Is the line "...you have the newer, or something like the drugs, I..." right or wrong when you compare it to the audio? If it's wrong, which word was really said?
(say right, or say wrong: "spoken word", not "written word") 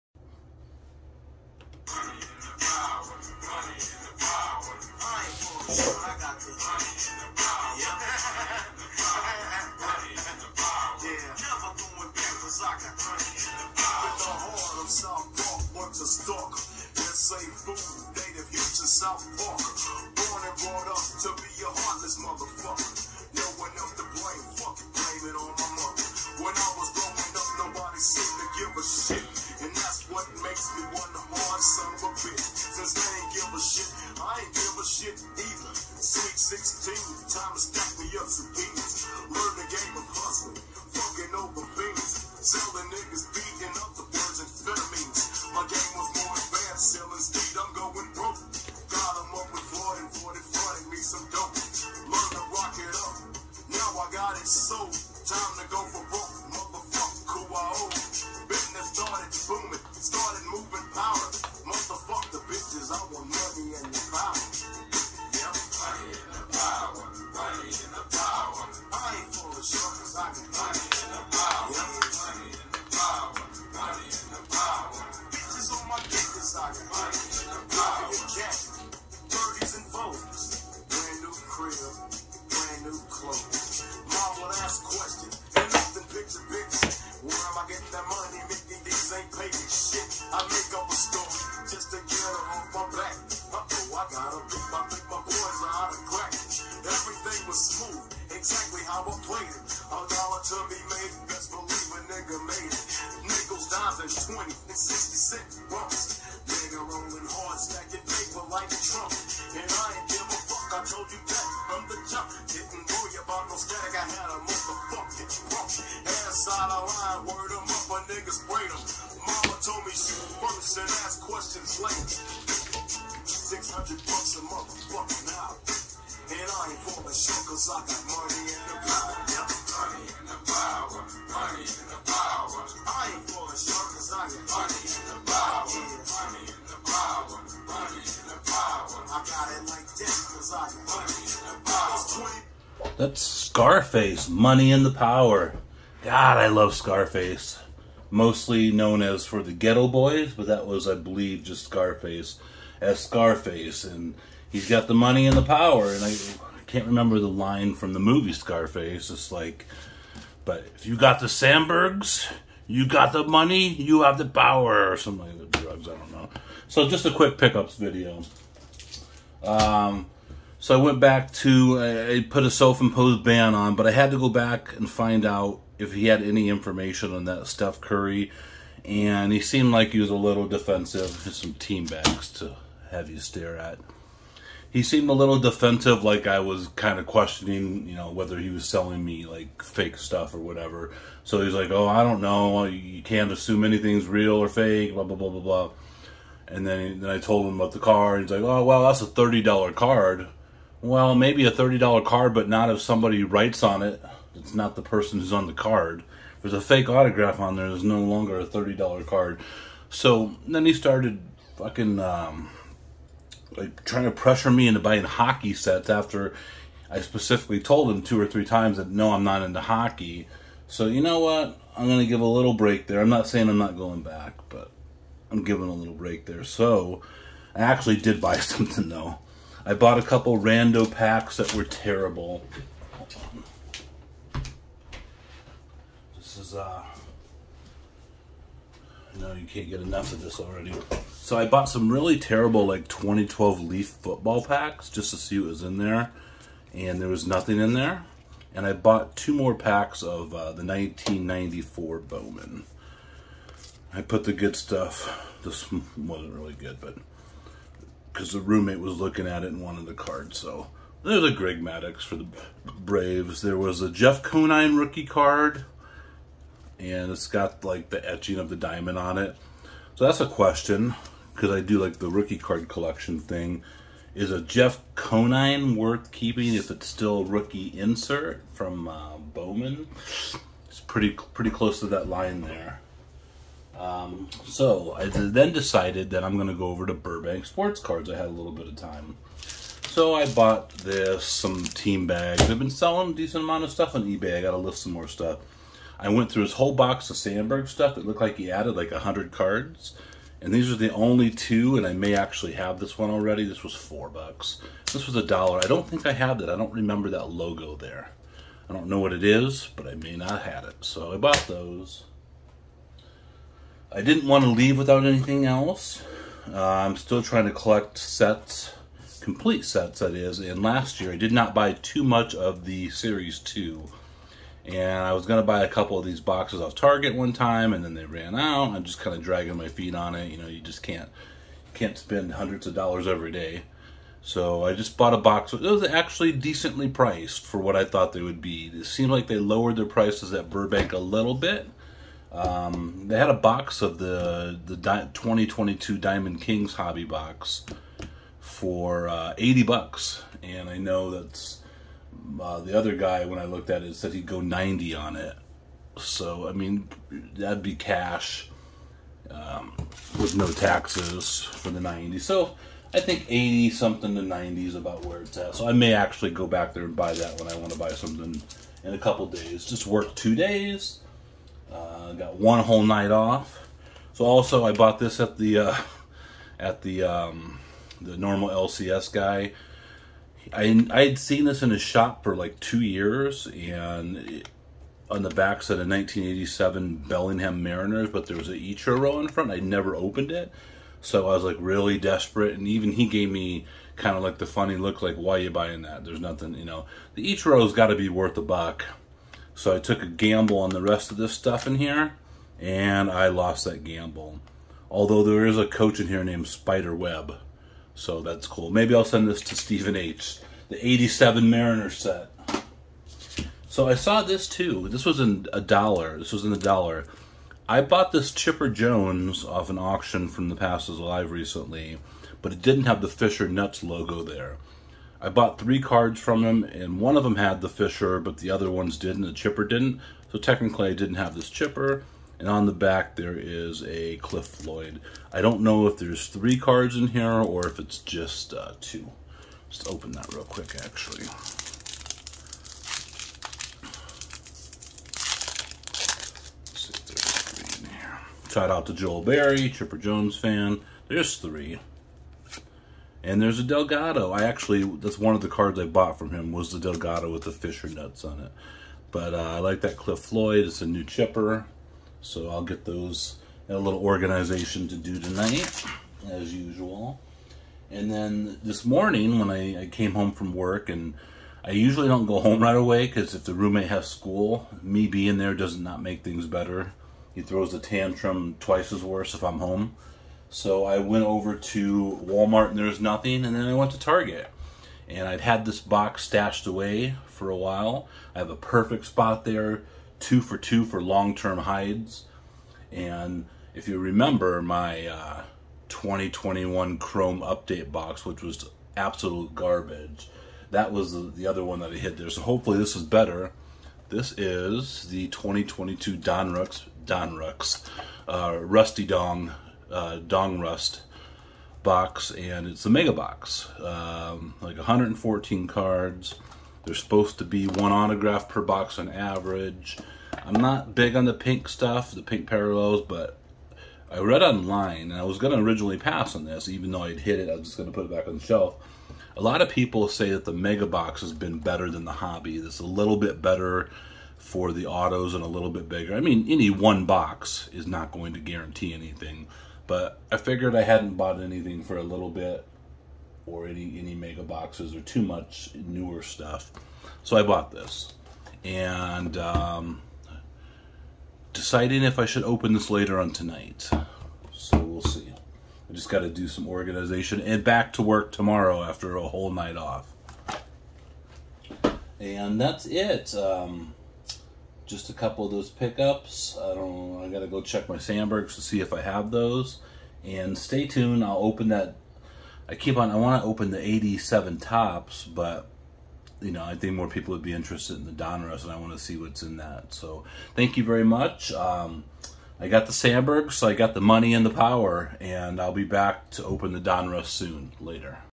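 wrong: "power", not "newer".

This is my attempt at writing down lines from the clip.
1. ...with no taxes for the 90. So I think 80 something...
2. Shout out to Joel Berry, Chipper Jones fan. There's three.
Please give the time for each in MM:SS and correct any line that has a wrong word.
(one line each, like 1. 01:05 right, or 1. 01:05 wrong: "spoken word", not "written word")
1. 06:00 right
2. 07:28 right.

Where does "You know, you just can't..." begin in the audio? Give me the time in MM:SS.
05:30.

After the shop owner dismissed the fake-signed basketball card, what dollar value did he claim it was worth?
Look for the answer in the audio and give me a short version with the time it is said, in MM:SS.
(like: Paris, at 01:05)
$30, at 03:19.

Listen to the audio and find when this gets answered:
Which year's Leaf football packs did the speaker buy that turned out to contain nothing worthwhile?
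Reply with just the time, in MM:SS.
04:02.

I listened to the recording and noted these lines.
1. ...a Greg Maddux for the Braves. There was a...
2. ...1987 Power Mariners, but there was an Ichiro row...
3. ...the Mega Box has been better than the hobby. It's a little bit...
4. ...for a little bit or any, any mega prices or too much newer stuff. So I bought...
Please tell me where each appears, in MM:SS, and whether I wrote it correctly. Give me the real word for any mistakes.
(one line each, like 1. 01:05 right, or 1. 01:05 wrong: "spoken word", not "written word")
1. 04:21 right
2. 06:25 wrong: "Bellingham", not "Power"
3. 08:50 right
4. 09:01 wrong: "boxes", not "prices".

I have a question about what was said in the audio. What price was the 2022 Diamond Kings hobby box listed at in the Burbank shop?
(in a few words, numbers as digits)
$80.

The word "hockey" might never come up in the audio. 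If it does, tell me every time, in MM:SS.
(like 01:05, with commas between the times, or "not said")
03:35, 03:39.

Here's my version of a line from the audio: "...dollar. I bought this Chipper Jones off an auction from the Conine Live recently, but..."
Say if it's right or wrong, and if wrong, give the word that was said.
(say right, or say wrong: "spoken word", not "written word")
wrong: "Passes", not "Conine".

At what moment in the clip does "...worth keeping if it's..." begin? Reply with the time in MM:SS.
04:35.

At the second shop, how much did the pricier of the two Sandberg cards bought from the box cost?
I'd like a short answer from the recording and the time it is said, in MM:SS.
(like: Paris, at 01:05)
$4, at 05:03.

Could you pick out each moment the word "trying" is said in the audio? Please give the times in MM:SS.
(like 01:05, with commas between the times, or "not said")
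03:33, 05:17.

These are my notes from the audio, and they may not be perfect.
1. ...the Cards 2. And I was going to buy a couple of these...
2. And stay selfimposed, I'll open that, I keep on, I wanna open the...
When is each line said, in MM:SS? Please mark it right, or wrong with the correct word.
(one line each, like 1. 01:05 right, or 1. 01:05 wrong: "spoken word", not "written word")
1. 05:22 wrong: "Series", not "Cards"
2. 09:30 wrong: "tuned", not "selfimposed".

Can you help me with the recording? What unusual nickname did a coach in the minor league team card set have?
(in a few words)
Spider Web.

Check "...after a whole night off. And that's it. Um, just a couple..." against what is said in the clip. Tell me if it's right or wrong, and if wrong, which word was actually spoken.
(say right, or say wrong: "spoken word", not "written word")
right.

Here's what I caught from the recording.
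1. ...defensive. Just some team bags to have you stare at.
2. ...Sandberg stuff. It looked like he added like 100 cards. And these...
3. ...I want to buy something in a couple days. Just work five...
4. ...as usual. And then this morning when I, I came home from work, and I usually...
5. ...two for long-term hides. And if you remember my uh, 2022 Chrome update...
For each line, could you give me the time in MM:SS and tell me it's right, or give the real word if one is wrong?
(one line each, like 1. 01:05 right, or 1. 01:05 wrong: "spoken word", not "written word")
1. 03:00 right
2. 04:57 right
3. 06:07 wrong: "two", not "five"
4. 07:46 right
5. 08:10 wrong: "2021", not "2022".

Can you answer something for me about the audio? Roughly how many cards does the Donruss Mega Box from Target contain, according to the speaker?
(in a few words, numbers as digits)
114.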